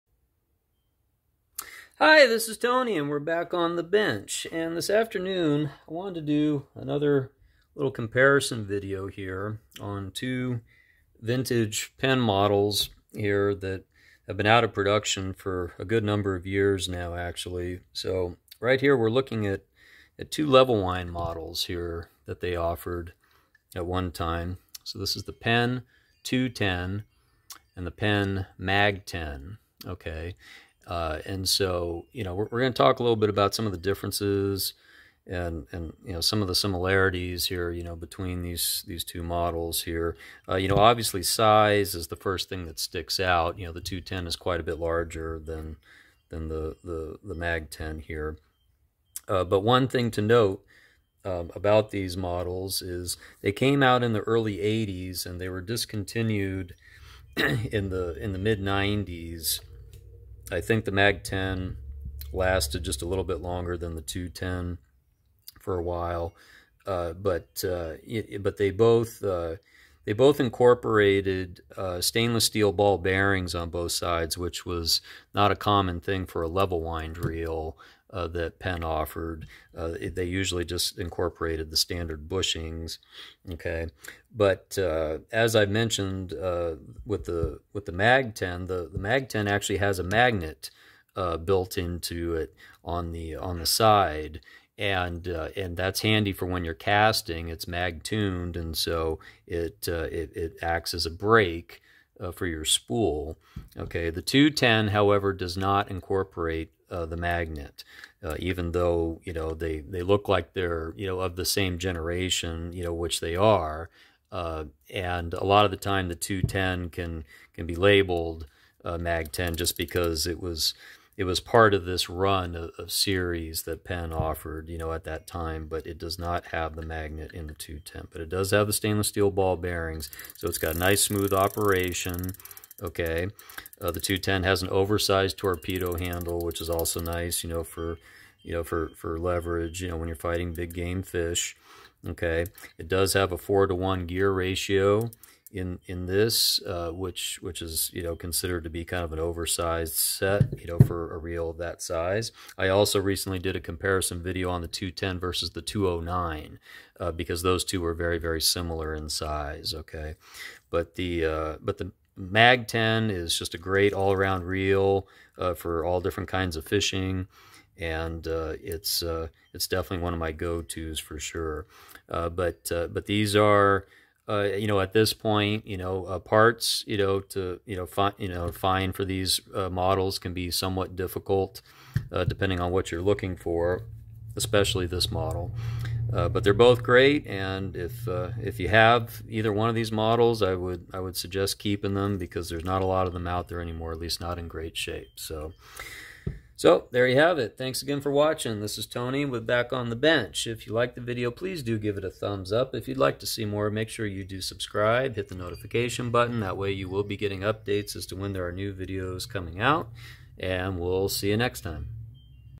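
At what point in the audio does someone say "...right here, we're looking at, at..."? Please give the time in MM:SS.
00:18.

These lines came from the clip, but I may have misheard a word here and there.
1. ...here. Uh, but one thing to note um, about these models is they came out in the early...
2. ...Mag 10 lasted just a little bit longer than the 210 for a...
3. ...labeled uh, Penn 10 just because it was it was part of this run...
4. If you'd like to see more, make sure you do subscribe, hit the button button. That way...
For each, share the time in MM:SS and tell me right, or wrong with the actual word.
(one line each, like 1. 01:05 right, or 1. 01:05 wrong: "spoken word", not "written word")
1. 00:47 right
2. 01:00 right
3. 01:57 wrong: "Mag", not "Penn"
4. 03:22 wrong: "notification", not "button".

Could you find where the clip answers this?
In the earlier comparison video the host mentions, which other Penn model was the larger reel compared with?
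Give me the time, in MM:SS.
02:35.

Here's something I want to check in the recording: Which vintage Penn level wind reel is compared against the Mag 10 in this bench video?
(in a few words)
Penn 210.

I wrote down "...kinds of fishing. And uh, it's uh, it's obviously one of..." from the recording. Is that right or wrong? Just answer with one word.
wrong.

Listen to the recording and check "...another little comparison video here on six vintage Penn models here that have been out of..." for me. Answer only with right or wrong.
wrong.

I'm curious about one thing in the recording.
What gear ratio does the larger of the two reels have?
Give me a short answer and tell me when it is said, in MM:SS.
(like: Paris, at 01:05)
4:1, at 02:23.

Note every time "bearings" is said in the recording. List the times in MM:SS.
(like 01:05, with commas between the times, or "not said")
01:12, 02:09.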